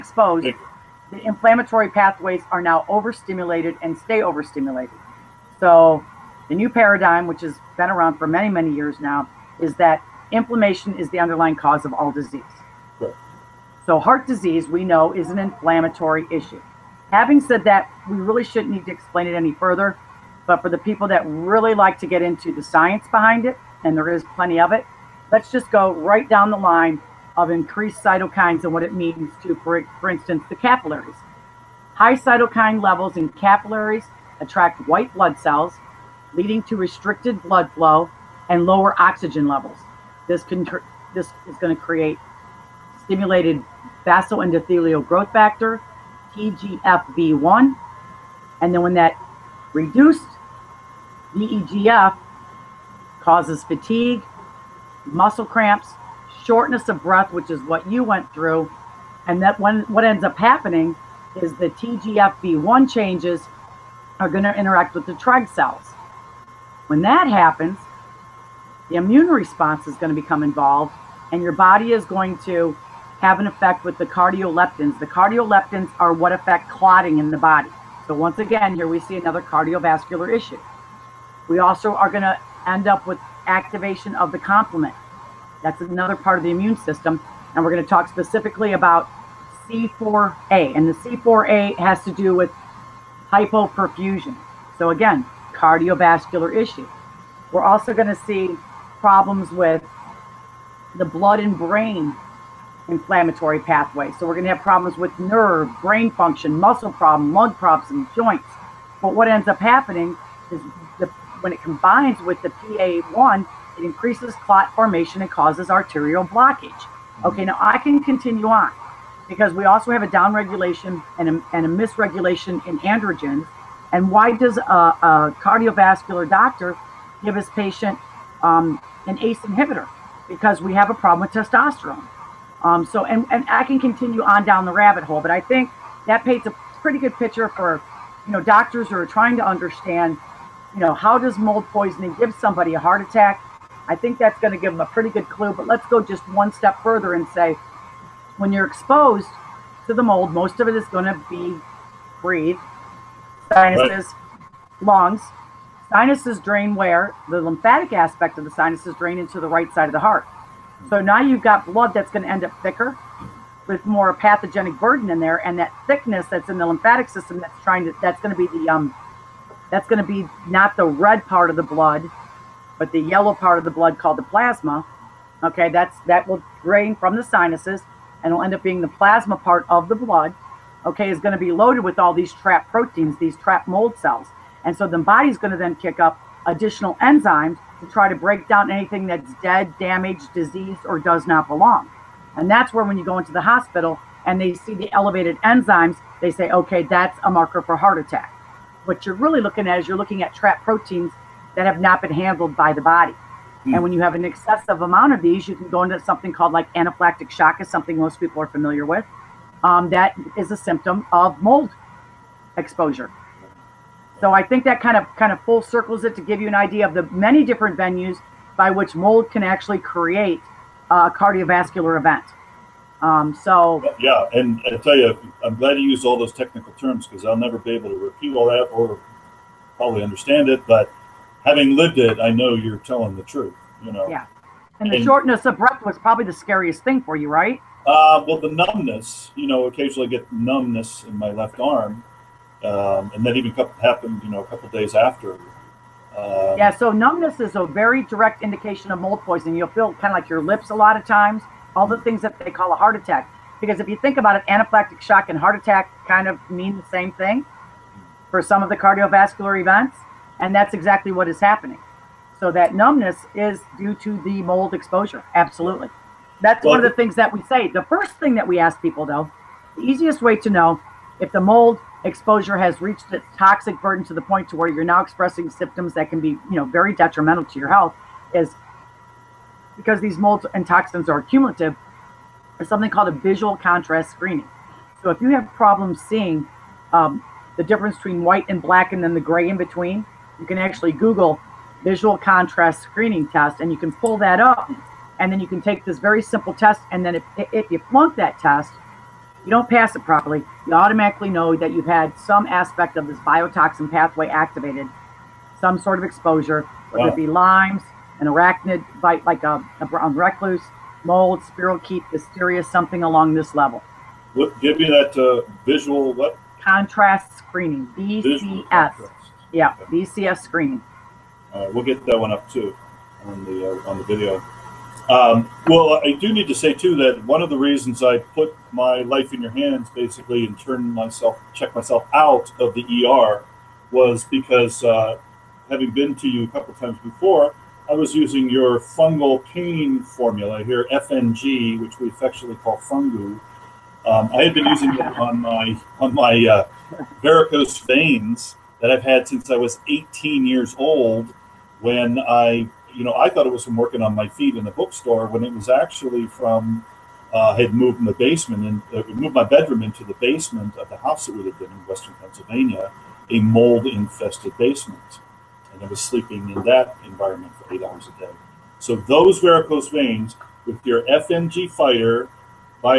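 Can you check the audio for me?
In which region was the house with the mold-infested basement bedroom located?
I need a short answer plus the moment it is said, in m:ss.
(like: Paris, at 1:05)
Western Pennsylvania, at 6:01.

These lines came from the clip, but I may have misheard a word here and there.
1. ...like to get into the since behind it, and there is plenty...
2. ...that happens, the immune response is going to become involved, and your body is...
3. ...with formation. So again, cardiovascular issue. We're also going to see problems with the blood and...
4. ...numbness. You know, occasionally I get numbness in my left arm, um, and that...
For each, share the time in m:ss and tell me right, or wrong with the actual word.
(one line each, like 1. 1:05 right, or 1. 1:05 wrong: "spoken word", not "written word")
1. 0:21 wrong: "science", not "since"
2. 1:07 right
3. 1:32 wrong: "hypoperfusion", not "formation"
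4. 3:58 right.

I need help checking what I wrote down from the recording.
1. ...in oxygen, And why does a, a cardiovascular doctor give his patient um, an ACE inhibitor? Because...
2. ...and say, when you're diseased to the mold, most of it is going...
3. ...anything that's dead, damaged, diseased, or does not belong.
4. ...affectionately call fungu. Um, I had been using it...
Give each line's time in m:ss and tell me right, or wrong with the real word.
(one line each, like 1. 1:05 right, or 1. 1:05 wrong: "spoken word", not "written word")
1. 2:02 wrong: "androgen", not "oxygen"
2. 2:27 wrong: "exposed", not "diseased"
3. 3:08 right
4. 5:42 right.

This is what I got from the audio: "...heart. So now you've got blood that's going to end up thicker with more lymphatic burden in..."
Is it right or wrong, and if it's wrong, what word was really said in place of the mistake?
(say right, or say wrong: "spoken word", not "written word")
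wrong: "pathogenic", not "lymphatic".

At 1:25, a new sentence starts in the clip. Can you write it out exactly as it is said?
That's another part of the immune system.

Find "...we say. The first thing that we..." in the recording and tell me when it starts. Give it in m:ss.
4:27.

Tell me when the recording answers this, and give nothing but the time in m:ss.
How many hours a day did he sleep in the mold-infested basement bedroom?
6:07.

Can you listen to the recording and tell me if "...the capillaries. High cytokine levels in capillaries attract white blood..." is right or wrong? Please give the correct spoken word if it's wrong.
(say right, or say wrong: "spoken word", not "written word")
right.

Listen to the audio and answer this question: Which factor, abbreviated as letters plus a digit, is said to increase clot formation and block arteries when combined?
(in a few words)
PA1.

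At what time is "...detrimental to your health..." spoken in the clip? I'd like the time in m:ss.
4:36.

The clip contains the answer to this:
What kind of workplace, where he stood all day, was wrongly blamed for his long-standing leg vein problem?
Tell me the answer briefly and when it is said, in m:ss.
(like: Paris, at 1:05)
bookstore, at 5:54.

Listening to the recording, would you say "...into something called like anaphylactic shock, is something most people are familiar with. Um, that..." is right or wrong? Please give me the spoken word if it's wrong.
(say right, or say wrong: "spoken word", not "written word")
right.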